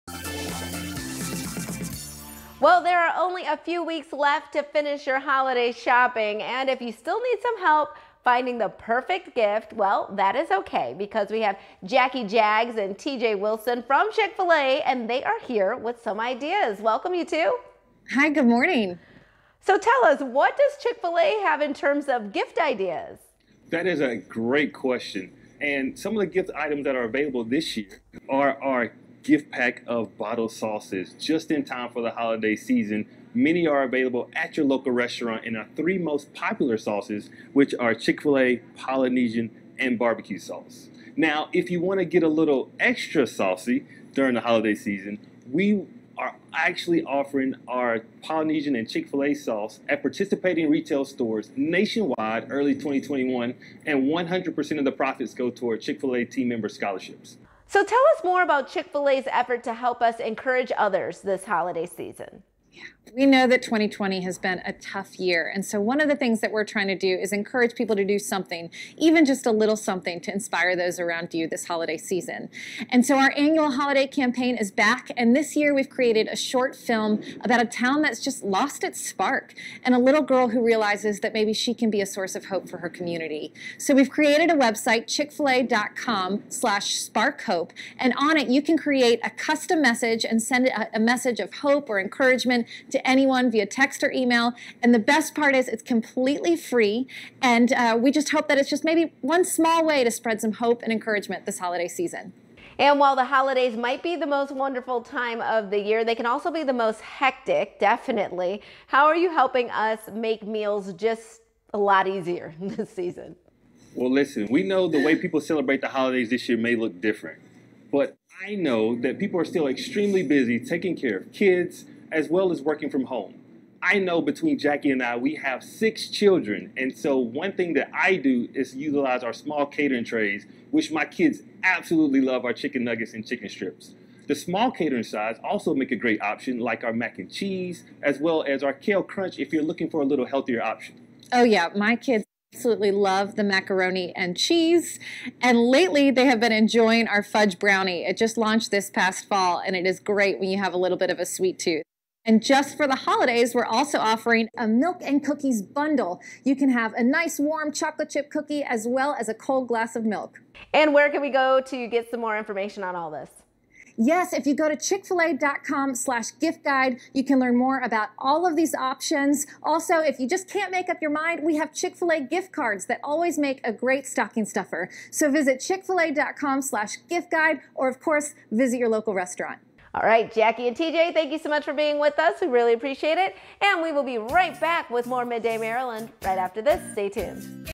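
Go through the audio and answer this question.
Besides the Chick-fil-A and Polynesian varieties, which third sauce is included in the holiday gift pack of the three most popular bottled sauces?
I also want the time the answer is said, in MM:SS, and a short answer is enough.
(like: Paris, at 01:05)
Barbecue sauce, at 00:39.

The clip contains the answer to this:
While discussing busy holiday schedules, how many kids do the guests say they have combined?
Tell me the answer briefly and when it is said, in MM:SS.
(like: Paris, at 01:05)
6, at 02:05.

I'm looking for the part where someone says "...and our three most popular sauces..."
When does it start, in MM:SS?
00:35.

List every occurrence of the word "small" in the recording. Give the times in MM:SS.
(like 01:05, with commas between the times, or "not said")
01:39, 02:09, 02:14.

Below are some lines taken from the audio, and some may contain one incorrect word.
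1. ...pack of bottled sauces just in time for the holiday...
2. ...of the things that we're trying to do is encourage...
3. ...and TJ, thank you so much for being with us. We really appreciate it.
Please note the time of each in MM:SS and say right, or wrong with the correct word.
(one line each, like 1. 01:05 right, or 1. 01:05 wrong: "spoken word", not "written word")
1. 00:29 right
2. 01:05 right
3. 03:00 right.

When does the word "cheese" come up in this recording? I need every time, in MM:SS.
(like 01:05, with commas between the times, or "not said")
02:17, 02:24.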